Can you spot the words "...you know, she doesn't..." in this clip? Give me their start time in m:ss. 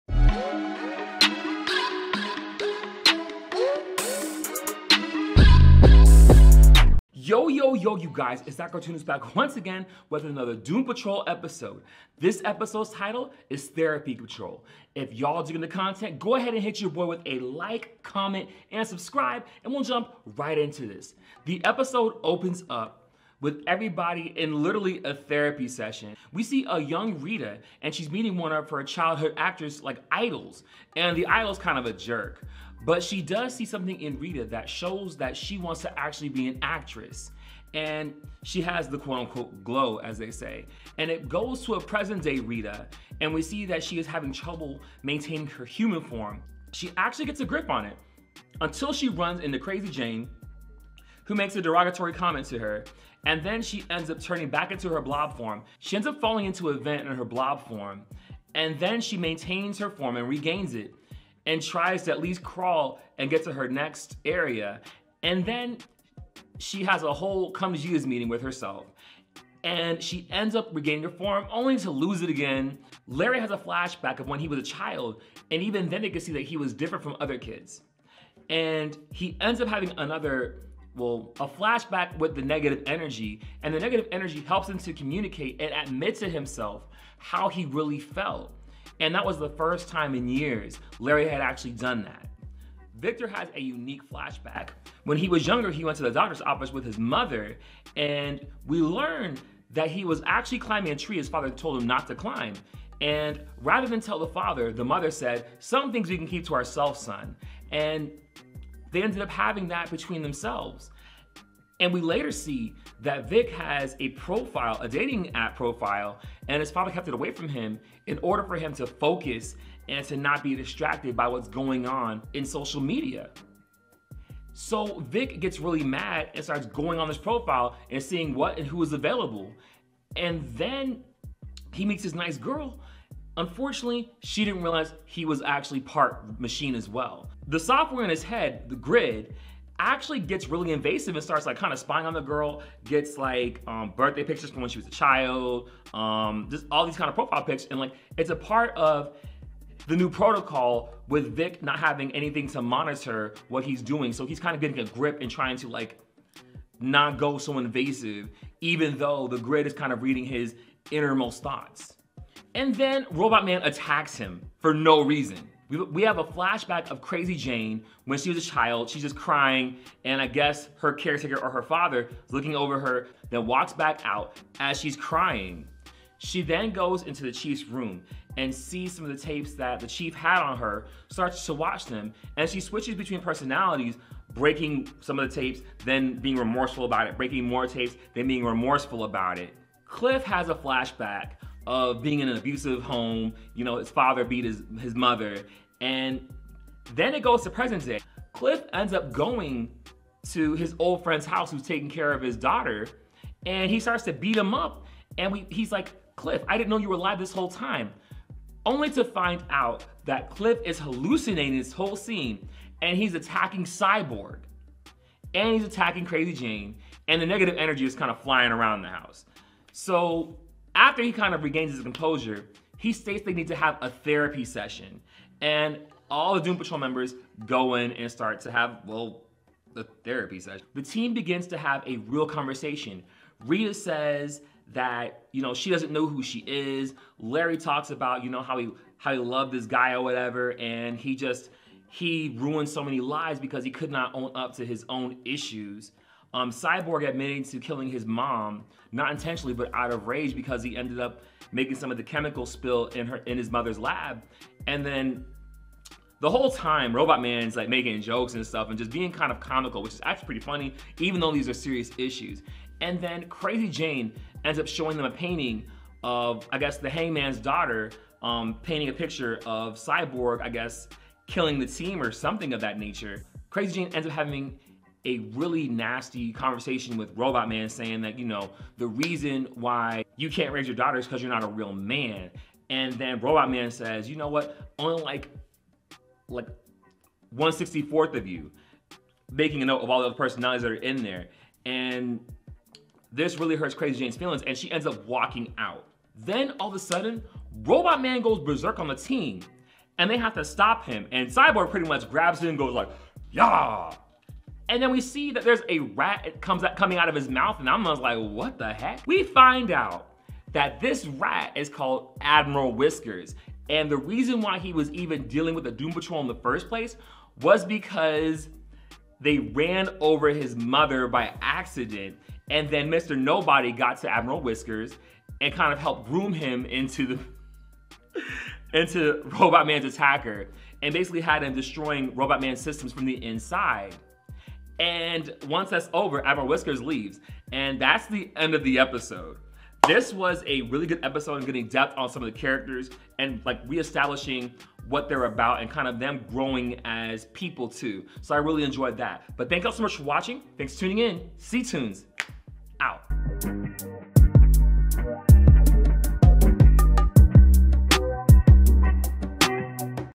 3:55.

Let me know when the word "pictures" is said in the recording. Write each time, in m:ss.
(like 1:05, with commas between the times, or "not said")
2:24, 4:28.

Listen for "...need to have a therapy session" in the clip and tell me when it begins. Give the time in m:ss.
3:43.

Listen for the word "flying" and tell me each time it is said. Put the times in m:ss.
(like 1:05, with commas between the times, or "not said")
3:38.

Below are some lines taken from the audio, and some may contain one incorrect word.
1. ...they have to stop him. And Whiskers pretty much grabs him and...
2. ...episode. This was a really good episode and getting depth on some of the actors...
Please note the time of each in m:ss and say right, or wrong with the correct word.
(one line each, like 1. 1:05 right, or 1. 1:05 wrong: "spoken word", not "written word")
1. 5:00 wrong: "Cyborg", not "Whiskers"
2. 5:38 wrong: "characters", not "actors".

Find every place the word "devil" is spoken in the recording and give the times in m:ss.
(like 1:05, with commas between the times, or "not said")
not said.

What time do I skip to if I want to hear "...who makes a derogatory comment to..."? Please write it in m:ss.
0:51.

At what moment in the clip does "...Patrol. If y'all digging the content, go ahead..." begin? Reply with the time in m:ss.
0:14.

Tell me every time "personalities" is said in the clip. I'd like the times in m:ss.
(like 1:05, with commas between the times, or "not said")
3:03, 4:50.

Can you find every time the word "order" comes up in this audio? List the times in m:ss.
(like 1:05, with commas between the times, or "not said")
1:58.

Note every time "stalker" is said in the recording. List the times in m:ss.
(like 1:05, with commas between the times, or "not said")
not said.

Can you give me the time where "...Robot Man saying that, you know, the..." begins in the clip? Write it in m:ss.
4:37.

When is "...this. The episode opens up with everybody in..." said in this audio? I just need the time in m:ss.
0:20.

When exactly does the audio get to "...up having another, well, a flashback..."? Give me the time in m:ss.
1:19.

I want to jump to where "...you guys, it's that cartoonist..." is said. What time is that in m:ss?
0:07.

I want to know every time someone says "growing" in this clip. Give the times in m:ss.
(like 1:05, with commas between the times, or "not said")
5:46.